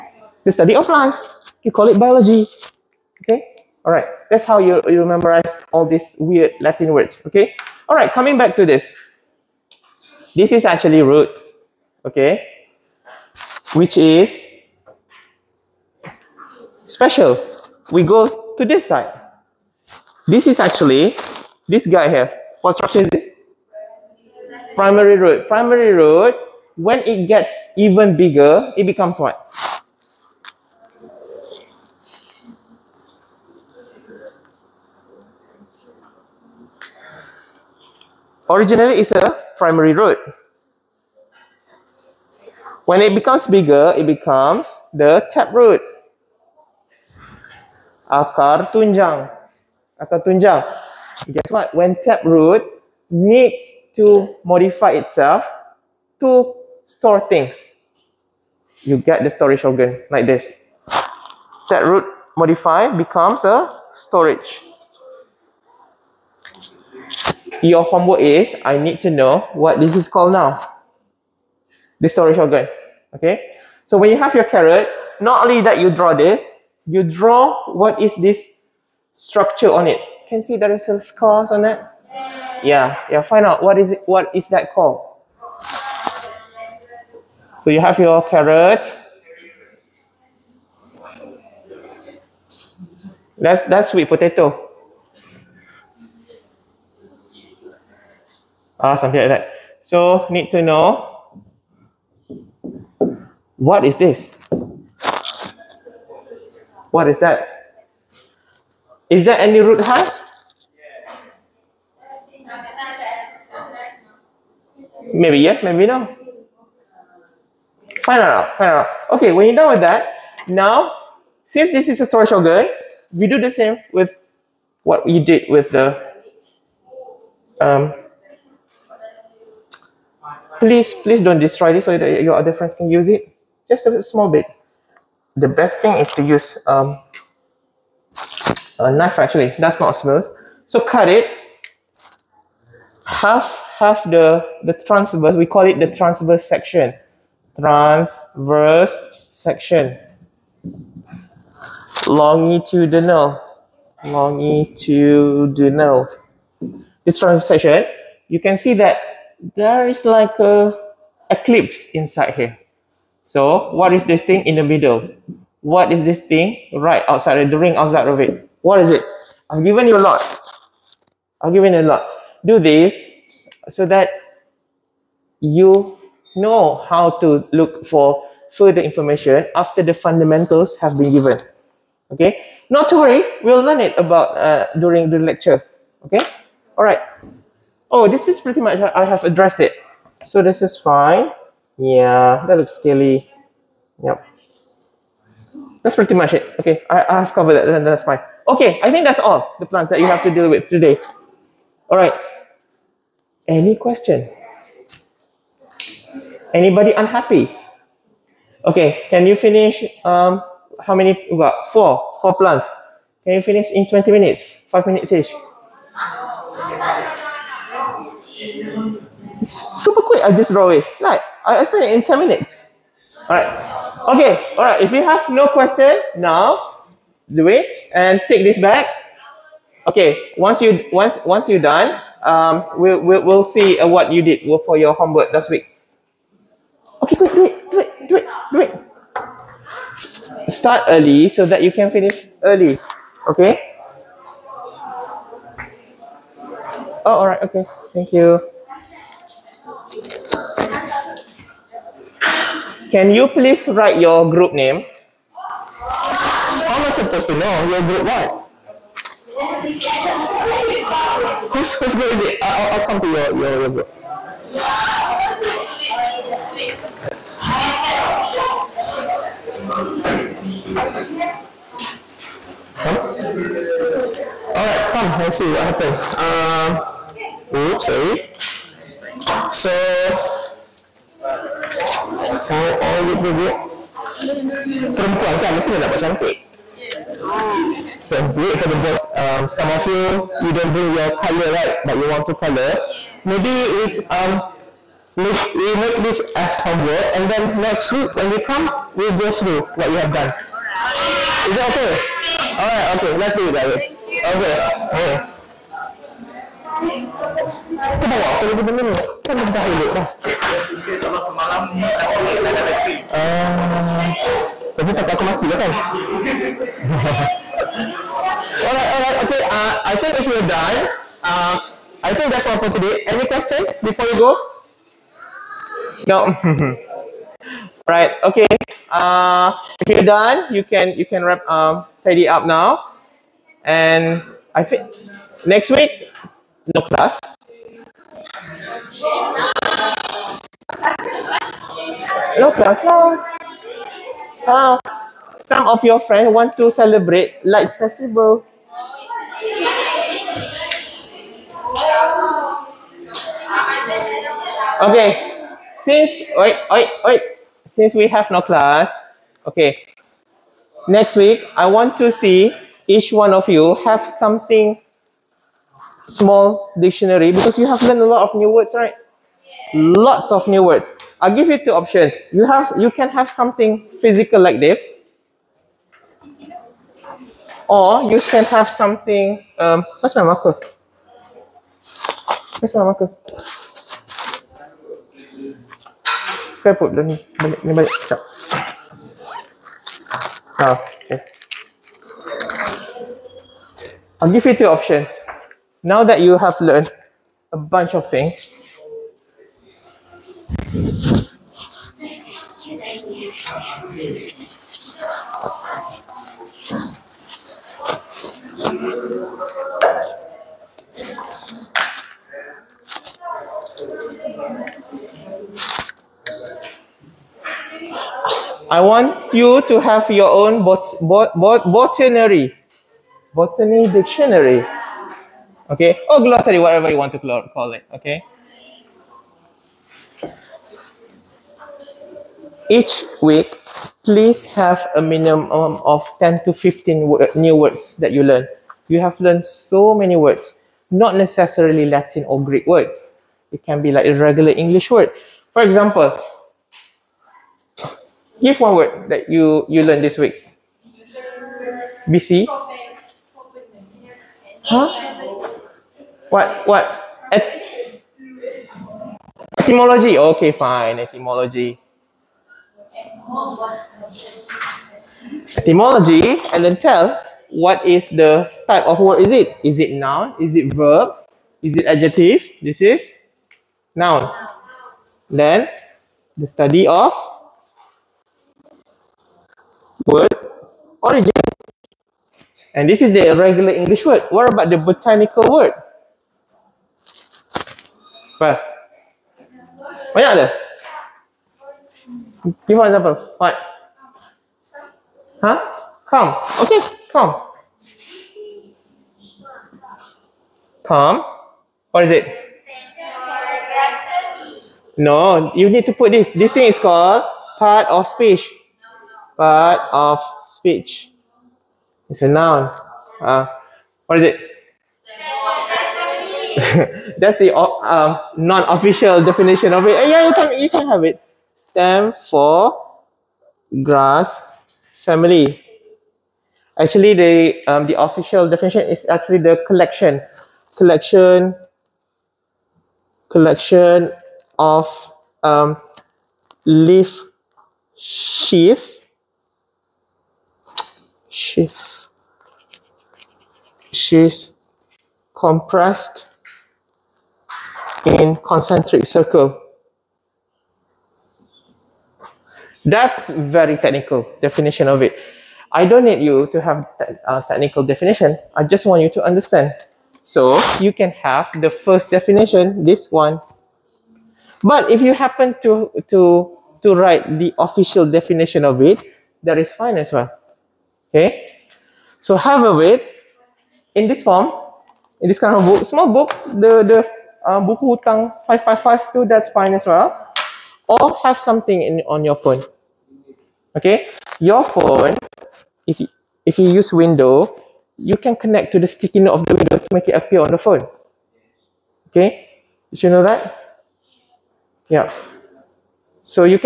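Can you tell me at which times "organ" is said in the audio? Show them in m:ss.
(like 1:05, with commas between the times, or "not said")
0:59, 1:12.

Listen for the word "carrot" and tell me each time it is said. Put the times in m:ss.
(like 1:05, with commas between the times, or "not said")
1:14, 1:28.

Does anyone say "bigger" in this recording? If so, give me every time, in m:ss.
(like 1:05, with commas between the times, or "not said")
0:28, 0:43.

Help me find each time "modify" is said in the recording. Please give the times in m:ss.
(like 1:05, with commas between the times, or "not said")
0:54, 1:02.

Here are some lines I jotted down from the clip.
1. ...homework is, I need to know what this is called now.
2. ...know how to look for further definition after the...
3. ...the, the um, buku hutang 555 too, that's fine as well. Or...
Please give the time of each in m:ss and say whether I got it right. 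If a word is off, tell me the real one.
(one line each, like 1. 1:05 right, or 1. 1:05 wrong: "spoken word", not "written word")
1. 1:07 right
2. 2:56 wrong: "information", not "definition"
3. 9:36 right.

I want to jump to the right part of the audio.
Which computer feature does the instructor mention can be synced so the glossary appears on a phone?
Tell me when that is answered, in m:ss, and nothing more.
9:48.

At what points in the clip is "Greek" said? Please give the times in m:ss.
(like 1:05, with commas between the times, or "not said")
7:22.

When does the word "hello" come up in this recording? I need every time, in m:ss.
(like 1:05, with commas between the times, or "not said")
not said.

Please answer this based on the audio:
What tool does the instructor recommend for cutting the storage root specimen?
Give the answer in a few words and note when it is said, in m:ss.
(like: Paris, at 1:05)
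a knife, at 2:18.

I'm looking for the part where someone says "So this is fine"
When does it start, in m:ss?
3:10.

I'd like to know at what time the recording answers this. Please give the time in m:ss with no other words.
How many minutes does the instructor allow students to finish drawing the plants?
3:33.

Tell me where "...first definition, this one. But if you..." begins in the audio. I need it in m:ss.
9:21.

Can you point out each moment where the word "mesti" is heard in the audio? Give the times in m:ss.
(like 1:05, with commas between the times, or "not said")
4:45.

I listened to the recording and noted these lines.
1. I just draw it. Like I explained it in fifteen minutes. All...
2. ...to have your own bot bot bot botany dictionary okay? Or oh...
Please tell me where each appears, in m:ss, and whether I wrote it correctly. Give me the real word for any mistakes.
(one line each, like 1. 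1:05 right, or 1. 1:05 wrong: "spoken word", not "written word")
1. 3:40 wrong: "ten", not "fifteen"
2. 6:59 right.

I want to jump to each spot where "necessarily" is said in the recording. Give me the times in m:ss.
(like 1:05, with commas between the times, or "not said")
7:21.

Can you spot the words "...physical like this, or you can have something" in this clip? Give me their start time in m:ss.
6:13.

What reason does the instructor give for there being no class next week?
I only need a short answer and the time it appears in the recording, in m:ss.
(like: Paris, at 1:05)
lights festival, at 5:47.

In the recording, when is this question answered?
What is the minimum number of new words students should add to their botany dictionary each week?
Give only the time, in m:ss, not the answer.
7:16.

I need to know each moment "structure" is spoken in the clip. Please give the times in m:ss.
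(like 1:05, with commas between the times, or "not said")
0:22, 1:19.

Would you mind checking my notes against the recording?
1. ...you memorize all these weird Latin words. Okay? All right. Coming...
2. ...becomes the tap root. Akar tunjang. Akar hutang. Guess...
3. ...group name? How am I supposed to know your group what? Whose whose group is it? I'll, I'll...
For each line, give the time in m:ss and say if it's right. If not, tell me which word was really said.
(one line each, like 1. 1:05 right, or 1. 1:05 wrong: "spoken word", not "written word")
1. 0:04 right
2. 0:44 wrong: "tunjang", not "hutang"
3. 4:14 right.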